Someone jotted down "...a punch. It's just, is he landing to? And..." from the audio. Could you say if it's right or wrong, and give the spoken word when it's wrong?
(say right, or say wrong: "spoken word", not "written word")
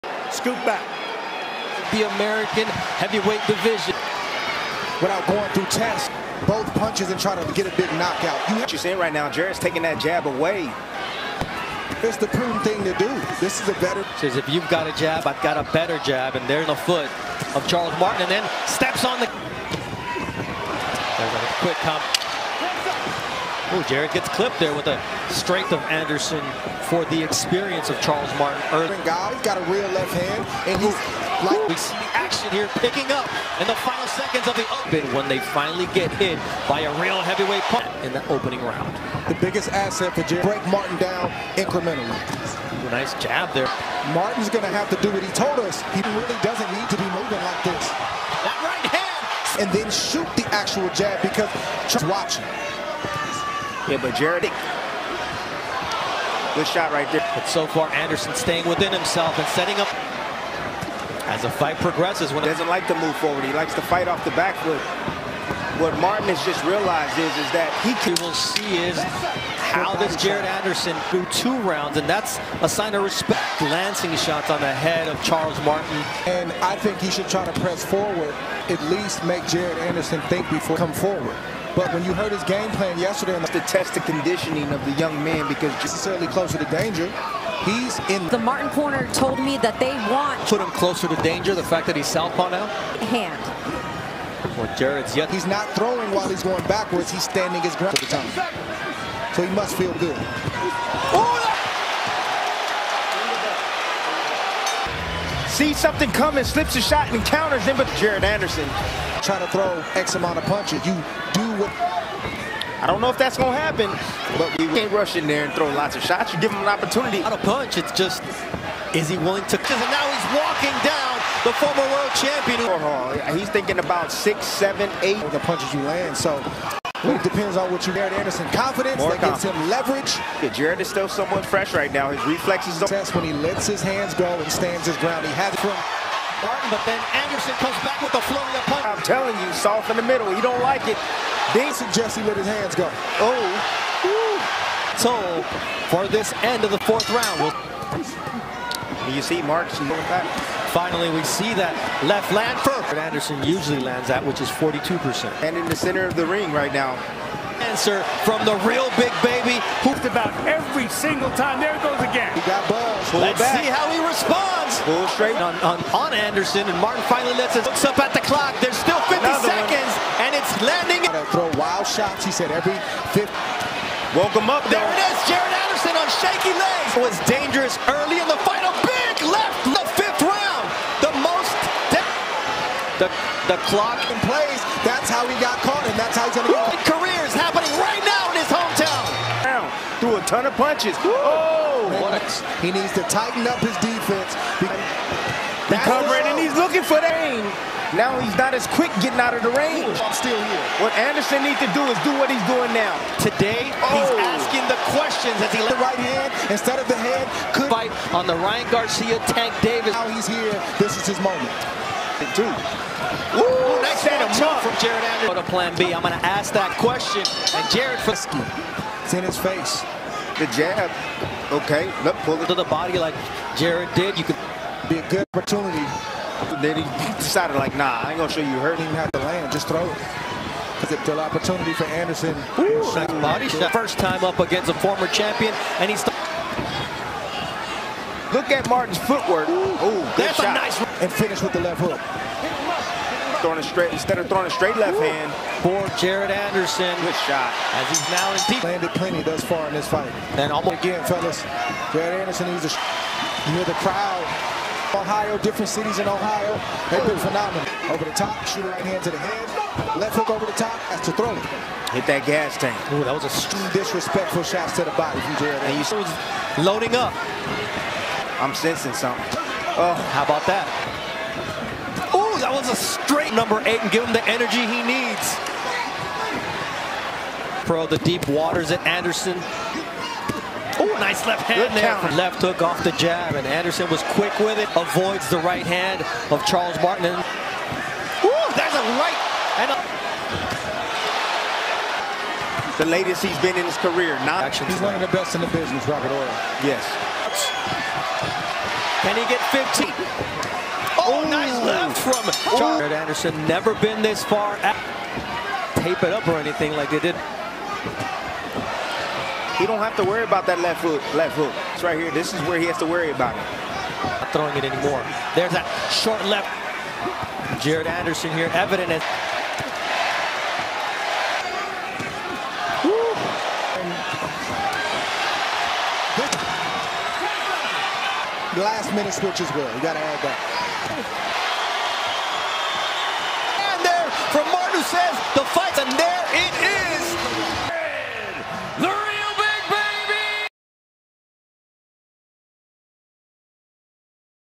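wrong: "willing", not "landing".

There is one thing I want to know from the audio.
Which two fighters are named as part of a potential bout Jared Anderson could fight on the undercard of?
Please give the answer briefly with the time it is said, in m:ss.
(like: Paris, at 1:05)
Ryan Garcia, Tank Davis, at 3:28.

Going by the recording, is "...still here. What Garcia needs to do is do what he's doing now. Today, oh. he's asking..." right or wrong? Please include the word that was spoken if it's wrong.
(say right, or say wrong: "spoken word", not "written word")
wrong: "Anderson", not "Garcia".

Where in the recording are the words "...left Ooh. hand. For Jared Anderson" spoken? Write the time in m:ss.
4:04.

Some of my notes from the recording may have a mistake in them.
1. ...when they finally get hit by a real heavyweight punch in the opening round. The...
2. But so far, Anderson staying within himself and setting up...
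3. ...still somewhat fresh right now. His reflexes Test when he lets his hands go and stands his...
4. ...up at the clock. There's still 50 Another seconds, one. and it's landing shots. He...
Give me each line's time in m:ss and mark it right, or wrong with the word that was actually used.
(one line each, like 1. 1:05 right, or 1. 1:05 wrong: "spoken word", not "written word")
1. 0:35 right
2. 0:57 right
3. 2:10 right
4. 2:47 right.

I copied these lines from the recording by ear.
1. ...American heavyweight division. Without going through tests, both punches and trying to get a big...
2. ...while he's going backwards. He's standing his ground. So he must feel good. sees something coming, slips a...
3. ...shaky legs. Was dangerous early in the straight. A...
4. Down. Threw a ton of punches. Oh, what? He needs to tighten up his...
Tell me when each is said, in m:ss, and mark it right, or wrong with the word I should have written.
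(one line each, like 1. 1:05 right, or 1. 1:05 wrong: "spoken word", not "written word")
1. 0:02 right
2. 1:36 right
3. 2:56 wrong: "fight", not "straight"
4. 3:09 right.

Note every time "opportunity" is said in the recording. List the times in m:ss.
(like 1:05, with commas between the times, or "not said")
1:56, 3:45, 3:51.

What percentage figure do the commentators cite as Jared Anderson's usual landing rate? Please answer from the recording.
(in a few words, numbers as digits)
42%.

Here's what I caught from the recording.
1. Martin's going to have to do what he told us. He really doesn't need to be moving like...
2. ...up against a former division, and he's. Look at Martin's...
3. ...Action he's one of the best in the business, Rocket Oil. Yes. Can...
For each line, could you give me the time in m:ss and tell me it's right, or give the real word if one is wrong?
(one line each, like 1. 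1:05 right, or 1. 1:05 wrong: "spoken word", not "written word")
1. 0:44 right
2. 3:54 wrong: "champion", not "division"
3. 4:54 right.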